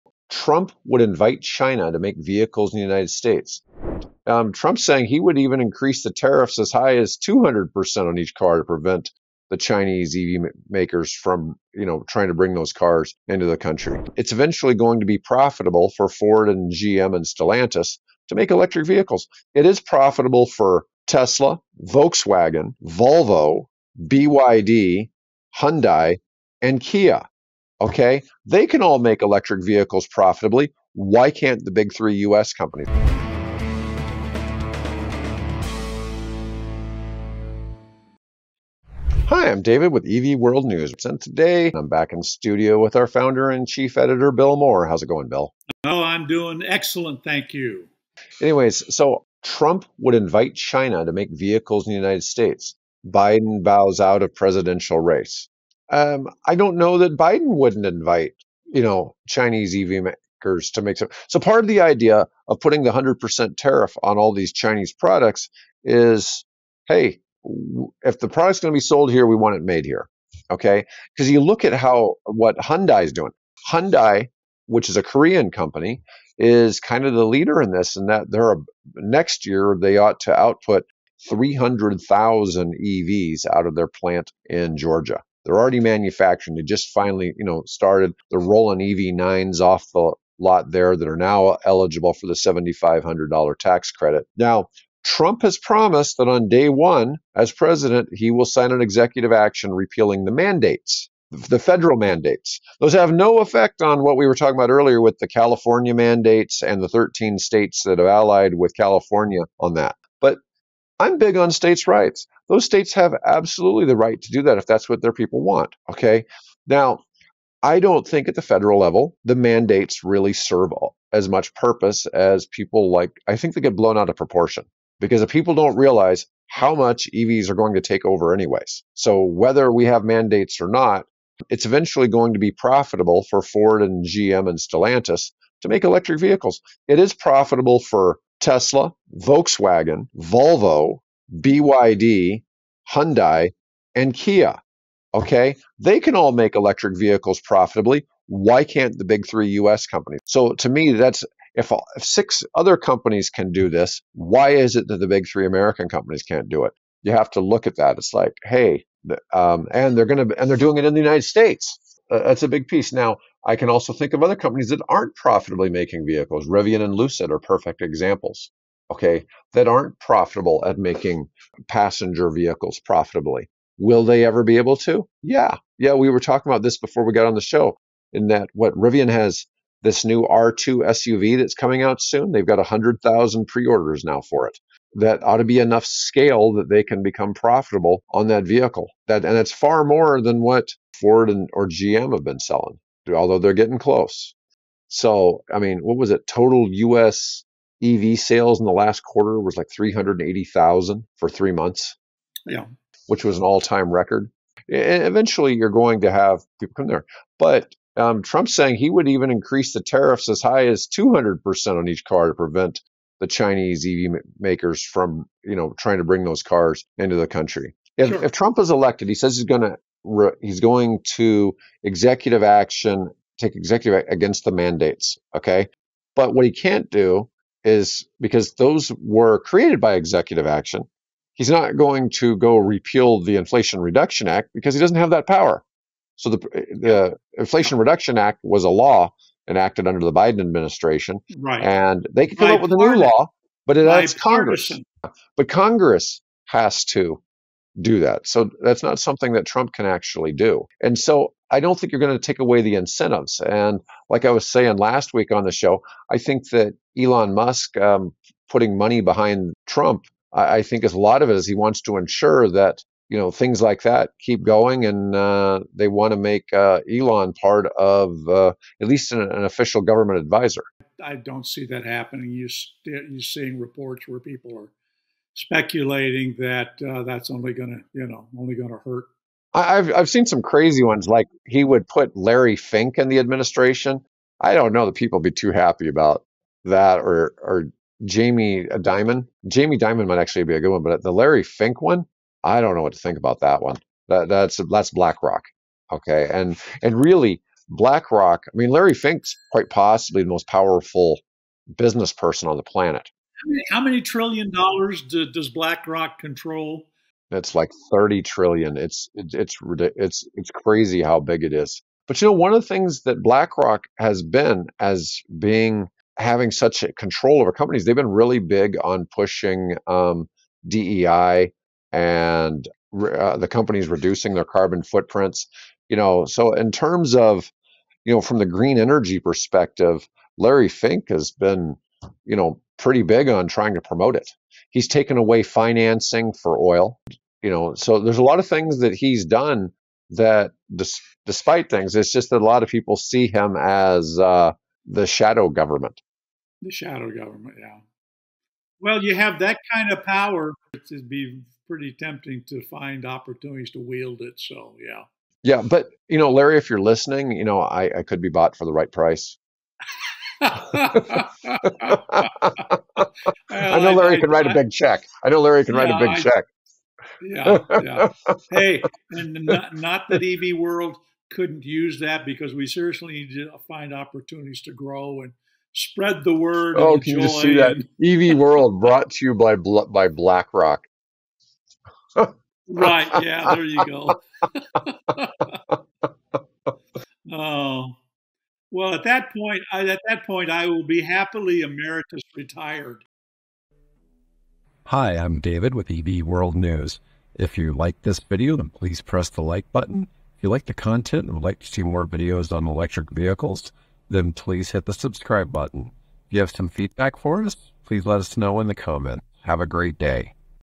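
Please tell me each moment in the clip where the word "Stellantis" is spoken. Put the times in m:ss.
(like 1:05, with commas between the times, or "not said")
0:17, 2:14.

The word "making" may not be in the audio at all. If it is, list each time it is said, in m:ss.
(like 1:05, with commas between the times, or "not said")
2:45, 2:50.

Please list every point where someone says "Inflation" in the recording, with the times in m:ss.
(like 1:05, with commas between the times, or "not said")
3:53, 3:57.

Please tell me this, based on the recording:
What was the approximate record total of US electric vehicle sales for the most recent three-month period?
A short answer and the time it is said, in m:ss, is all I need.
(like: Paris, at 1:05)
380,000, at 3:19.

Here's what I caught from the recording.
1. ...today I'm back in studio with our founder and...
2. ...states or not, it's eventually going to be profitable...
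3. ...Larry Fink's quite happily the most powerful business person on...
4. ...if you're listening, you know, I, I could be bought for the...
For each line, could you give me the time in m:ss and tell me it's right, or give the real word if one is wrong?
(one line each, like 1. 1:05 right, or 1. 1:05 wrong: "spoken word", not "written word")
1. 0:41 right
2. 2:10 wrong: "mandates", not "states"
3. 4:58 wrong: "possibly", not "happily"
4. 5:56 right.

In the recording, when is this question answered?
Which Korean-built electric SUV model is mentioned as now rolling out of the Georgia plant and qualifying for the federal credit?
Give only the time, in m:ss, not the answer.
1:28.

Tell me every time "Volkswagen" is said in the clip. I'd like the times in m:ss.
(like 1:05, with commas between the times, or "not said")
0:21, 2:19.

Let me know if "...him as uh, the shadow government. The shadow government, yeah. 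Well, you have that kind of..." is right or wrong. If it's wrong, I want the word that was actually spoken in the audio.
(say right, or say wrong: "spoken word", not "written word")
right.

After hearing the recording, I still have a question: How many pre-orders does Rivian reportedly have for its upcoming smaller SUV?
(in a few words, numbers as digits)
100,000.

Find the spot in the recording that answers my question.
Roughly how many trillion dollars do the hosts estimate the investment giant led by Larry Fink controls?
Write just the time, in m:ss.
5:07.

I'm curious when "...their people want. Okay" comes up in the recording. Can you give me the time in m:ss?
1:55.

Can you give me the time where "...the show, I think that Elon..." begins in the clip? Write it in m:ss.
4:15.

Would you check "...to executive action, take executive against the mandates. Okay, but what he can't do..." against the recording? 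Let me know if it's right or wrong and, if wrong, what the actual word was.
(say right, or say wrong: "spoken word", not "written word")
right.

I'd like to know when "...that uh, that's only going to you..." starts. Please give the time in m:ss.
4:36.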